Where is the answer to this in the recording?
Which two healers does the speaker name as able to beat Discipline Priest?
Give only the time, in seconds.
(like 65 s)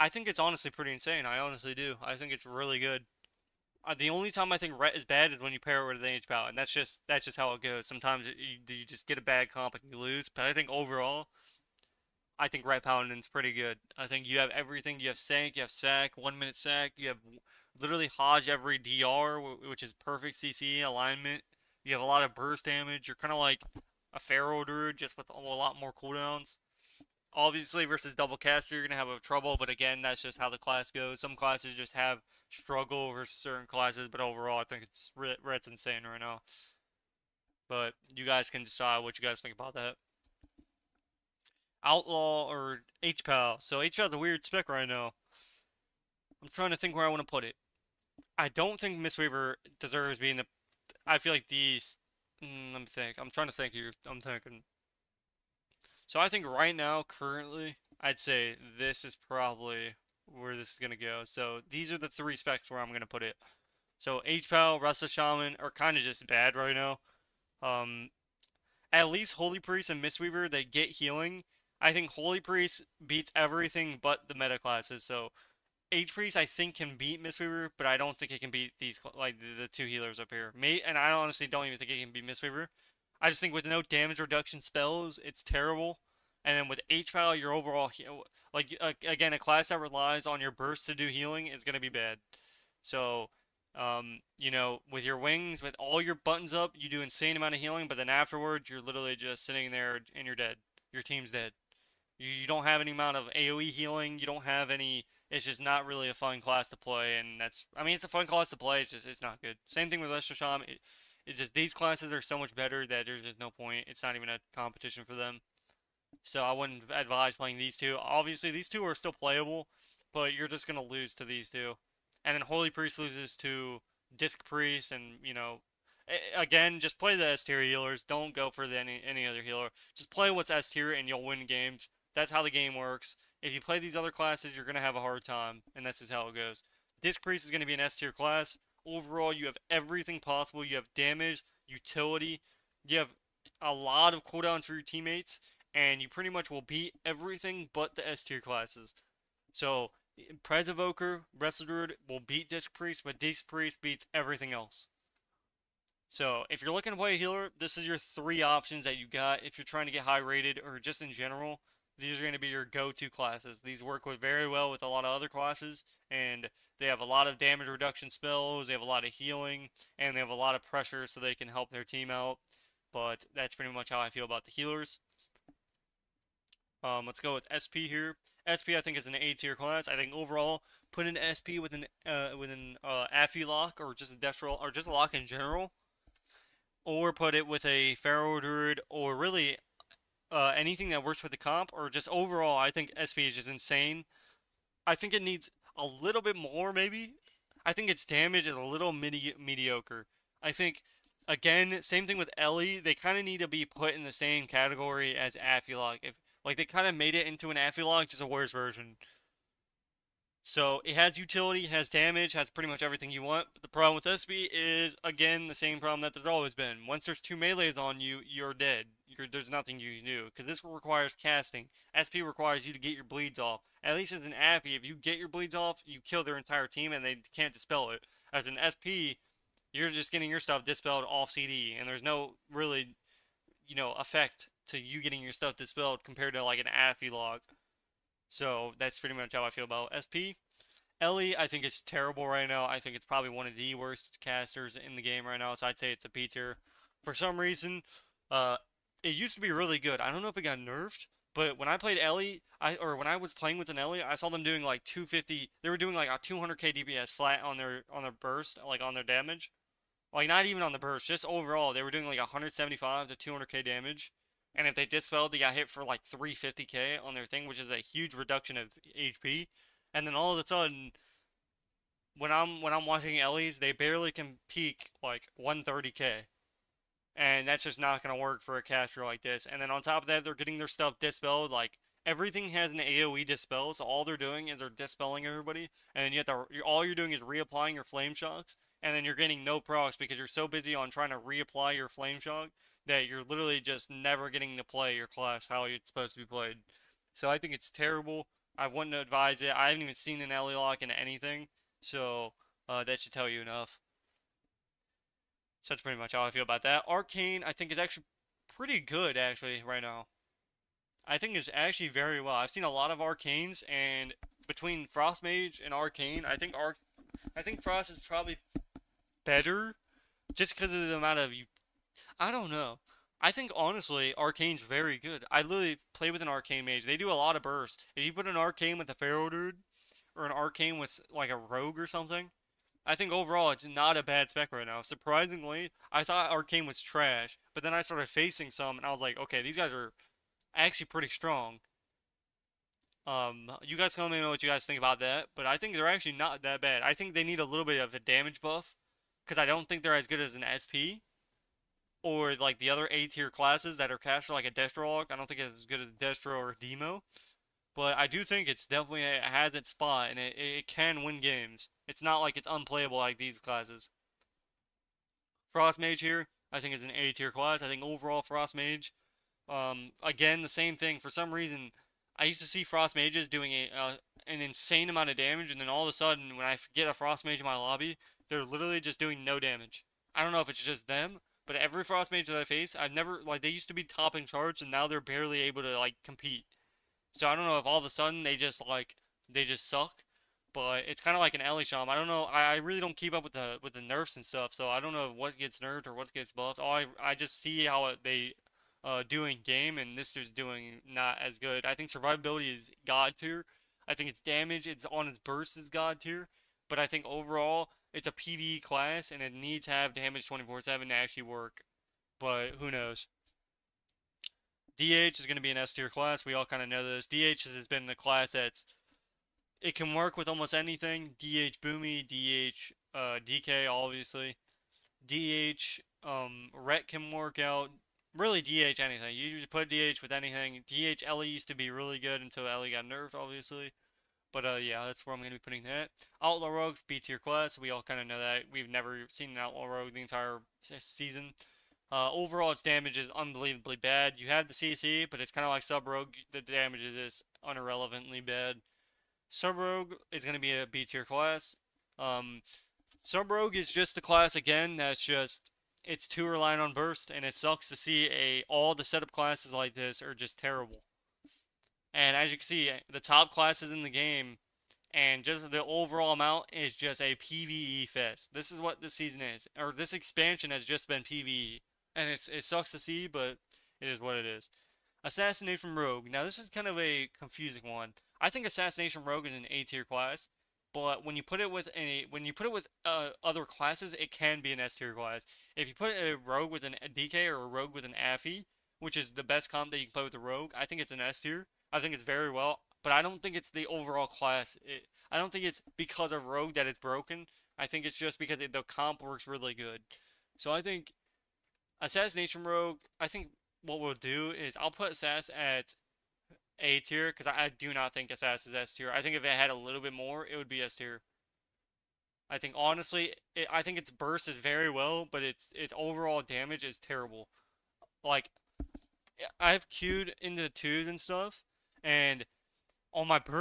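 150 s.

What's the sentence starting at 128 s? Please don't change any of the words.
Don't go for the, any, any other healer.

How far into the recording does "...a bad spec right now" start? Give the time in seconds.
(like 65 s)
333 s.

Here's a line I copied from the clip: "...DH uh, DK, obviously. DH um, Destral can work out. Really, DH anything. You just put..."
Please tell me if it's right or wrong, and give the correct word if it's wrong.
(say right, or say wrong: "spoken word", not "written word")
wrong: "Ret", not "Destral".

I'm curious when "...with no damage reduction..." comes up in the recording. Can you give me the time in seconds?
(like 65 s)
83 s.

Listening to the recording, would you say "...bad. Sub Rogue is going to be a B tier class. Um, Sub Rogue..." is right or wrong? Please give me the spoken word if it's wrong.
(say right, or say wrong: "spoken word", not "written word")
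right.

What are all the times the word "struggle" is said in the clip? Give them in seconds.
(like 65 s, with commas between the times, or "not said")
32 s.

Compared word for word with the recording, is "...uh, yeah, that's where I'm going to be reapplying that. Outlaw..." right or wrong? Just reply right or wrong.
wrong.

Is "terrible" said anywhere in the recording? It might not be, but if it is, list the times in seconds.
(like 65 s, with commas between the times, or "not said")
85 s, 241 s, 297 s, 460 s, 516 s.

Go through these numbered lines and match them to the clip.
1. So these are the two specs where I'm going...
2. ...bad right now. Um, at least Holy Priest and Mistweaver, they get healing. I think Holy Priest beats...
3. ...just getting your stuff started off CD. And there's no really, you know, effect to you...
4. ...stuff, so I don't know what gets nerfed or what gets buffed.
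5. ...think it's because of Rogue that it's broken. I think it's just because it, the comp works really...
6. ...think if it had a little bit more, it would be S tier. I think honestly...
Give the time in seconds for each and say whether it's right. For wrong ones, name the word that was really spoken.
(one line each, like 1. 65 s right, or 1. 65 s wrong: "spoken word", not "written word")
1. 61 s wrong: "three", not "two"
2. 66 s right
3. 229 s wrong: "dispelled", not "started"
4. 394 s right
5. 495 s right
6. 509 s right.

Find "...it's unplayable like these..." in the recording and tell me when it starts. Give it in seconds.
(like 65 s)
362 s.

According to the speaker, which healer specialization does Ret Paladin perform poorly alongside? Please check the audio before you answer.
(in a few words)
H Pow.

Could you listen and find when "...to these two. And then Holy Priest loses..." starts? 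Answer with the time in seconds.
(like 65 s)
121 s.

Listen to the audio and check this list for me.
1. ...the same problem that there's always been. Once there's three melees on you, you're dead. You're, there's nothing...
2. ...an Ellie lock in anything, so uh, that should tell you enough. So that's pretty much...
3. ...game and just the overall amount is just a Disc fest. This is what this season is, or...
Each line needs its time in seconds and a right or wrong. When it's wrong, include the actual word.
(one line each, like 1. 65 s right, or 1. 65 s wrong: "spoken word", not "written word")
1. 215 s wrong: "two", not "three"
2. 300 s right
3. 463 s wrong: "PvE", not "Disc".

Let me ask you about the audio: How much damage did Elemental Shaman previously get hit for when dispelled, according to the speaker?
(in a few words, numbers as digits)
350k.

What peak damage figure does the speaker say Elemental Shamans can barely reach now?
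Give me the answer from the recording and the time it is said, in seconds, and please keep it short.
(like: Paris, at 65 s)
130k, at 275 s.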